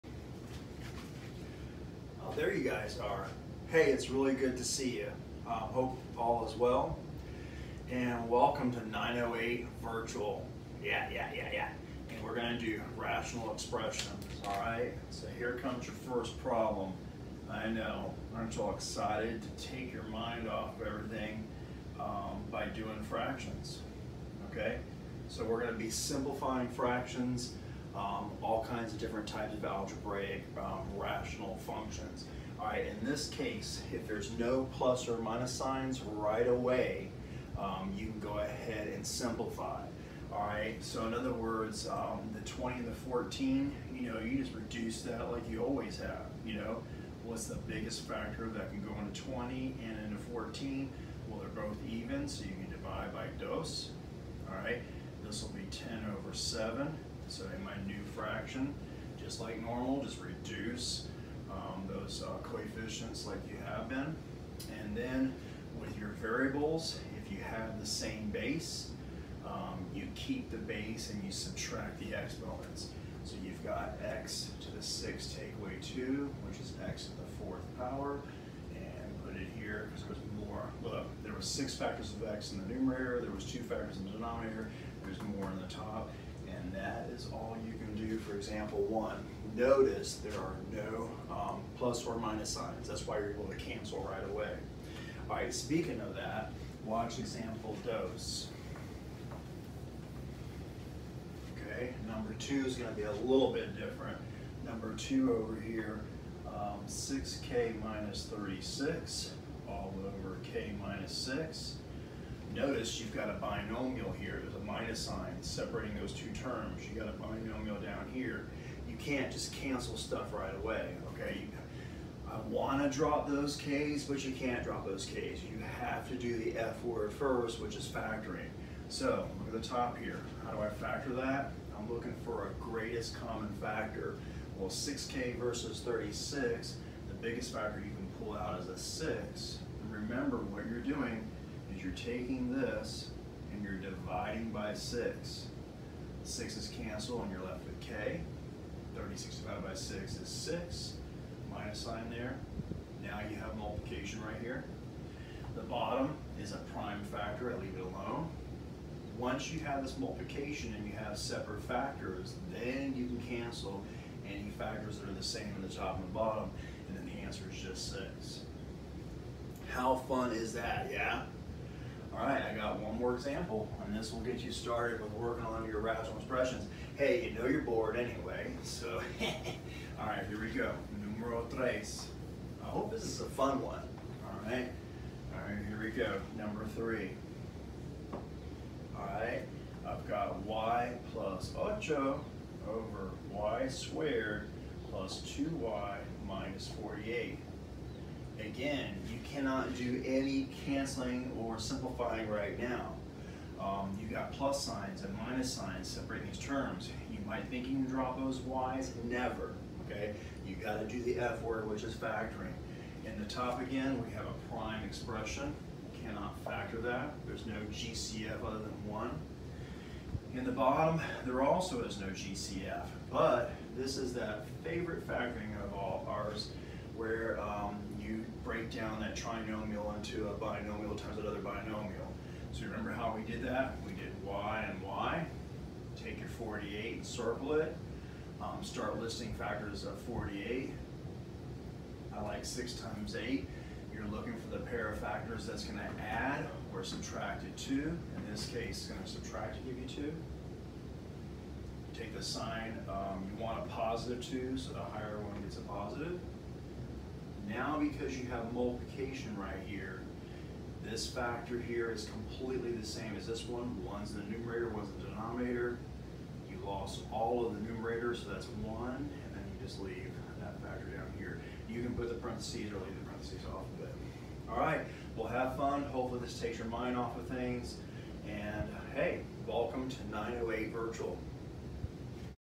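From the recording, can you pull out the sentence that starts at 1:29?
Notice there are no um, plus or minus signs.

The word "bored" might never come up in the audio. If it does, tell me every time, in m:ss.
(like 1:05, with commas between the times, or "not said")
2:57.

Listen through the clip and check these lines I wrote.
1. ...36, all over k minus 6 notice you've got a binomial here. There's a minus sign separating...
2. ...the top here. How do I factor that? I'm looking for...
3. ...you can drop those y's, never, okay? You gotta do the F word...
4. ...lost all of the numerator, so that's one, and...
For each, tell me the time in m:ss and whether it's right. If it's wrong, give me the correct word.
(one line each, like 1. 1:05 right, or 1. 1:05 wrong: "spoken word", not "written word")
1. 1:48 right
2. 2:09 right
3. 3:27 right
4. 4:26 right.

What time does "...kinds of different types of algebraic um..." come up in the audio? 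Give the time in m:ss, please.
0:28.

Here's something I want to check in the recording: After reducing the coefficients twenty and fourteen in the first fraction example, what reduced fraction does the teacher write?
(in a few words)
10 over 7.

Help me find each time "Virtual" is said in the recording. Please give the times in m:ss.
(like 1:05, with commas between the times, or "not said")
0:09, 4:40.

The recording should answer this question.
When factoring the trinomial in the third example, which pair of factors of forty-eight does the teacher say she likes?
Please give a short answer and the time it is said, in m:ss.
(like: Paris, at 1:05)
6 times 8, at 4:02.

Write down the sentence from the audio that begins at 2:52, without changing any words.
All right, I got one more example, and this will get you started with working on your rational expressions.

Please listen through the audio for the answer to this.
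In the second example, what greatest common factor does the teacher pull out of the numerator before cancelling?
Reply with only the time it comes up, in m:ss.
2:18.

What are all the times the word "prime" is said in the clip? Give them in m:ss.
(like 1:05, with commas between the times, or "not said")
2:36, 3:34.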